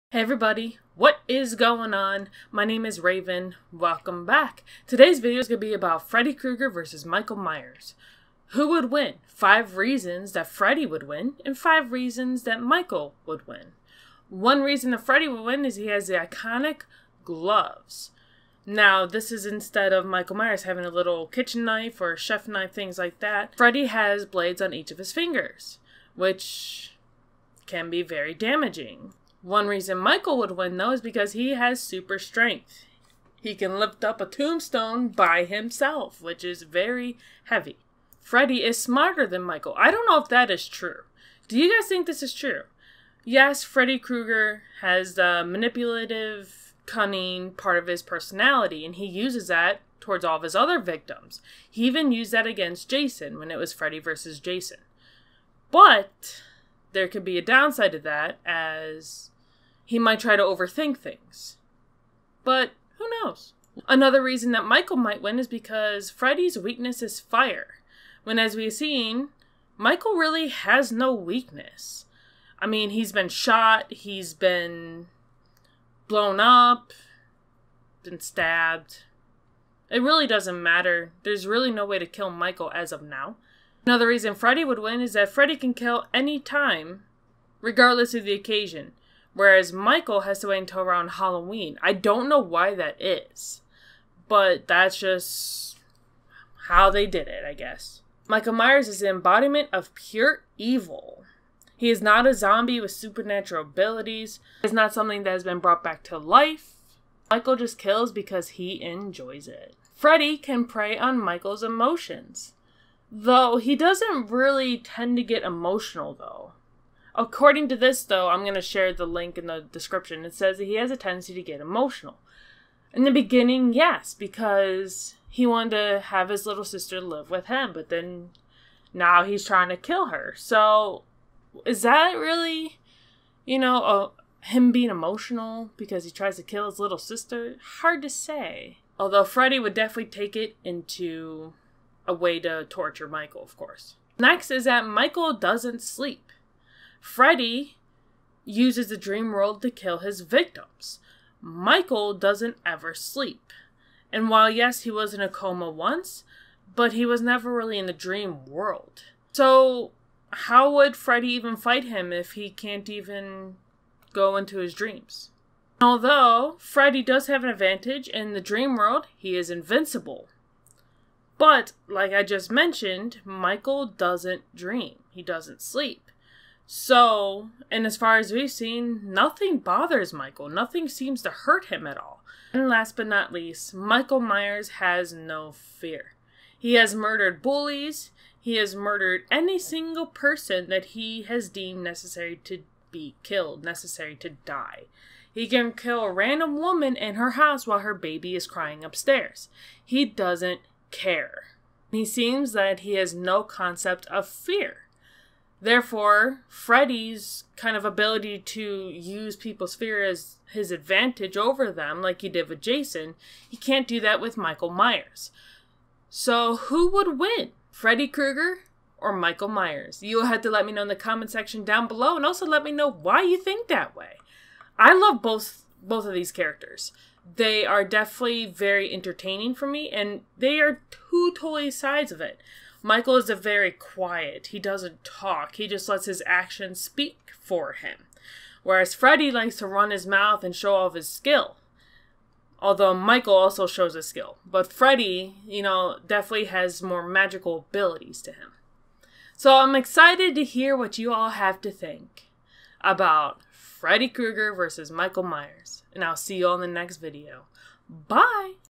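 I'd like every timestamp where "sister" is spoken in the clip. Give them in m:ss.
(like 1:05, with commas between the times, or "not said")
2:06, 2:16.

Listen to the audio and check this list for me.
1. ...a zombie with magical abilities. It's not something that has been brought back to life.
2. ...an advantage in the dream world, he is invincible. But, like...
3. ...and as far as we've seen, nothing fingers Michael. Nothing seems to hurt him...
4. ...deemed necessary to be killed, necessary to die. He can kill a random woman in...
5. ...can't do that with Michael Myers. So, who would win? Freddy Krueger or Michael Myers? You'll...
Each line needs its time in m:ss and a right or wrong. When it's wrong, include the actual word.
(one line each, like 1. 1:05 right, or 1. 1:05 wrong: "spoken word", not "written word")
1. 1:42 wrong: "supernatural", not "magical"
2. 2:47 right
3. 2:57 wrong: "bothers", not "fingers"
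4. 3:11 right
5. 3:33 right.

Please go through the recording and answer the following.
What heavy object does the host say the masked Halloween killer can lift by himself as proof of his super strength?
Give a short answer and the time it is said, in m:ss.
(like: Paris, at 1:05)
Tombstone, at 0:34.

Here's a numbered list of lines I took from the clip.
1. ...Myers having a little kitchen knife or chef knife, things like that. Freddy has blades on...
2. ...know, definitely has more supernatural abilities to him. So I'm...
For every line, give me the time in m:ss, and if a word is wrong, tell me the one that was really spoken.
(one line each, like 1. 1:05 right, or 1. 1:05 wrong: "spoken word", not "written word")
1. 0:20 right
2. 4:05 wrong: "magical", not "supernatural".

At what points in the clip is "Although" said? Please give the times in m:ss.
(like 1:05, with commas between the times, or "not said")
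2:18, 2:45, 4:02.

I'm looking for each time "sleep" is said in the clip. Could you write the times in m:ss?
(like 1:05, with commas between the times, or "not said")
2:25, 2:32, 2:55.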